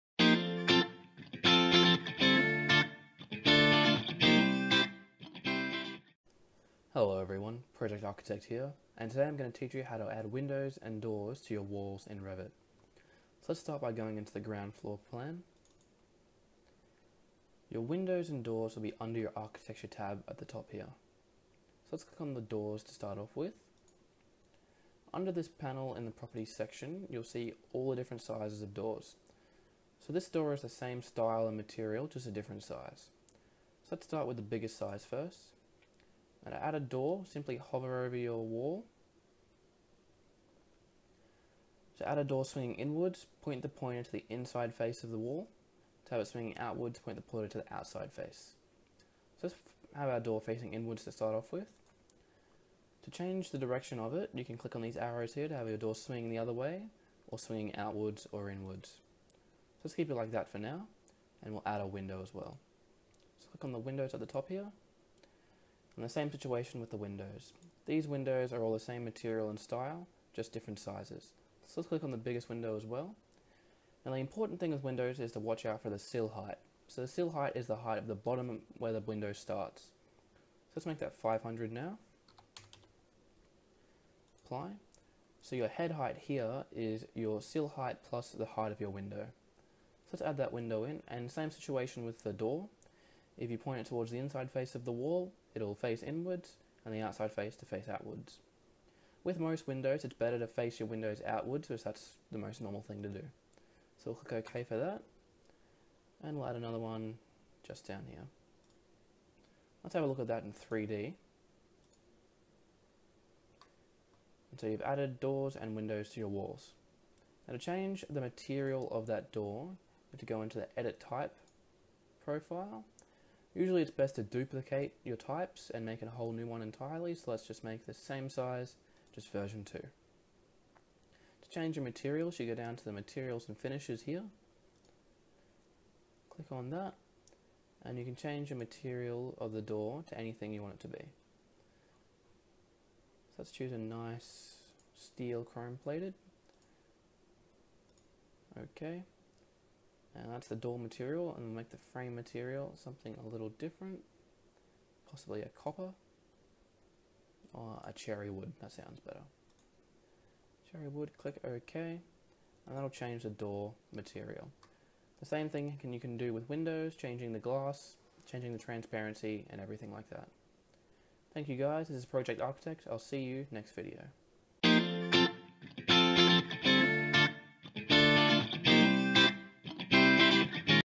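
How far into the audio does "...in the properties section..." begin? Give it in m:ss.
0:25.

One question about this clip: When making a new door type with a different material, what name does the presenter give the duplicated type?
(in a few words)
version 2.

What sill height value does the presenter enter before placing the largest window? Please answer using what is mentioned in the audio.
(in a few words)
500.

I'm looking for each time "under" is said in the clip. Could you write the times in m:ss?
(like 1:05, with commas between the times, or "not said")
0:18, 0:25.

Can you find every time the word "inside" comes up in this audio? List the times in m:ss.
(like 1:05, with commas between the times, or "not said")
0:44, 1:34.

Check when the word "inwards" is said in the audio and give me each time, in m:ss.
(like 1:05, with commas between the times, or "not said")
0:42, 0:50, 0:58, 1:36.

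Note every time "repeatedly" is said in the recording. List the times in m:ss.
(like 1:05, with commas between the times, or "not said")
not said.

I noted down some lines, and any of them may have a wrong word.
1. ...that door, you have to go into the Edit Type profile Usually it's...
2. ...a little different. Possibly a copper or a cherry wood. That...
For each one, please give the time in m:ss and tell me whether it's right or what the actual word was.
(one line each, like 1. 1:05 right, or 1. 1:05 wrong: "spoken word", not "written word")
1. 1:59 right
2. 2:33 right.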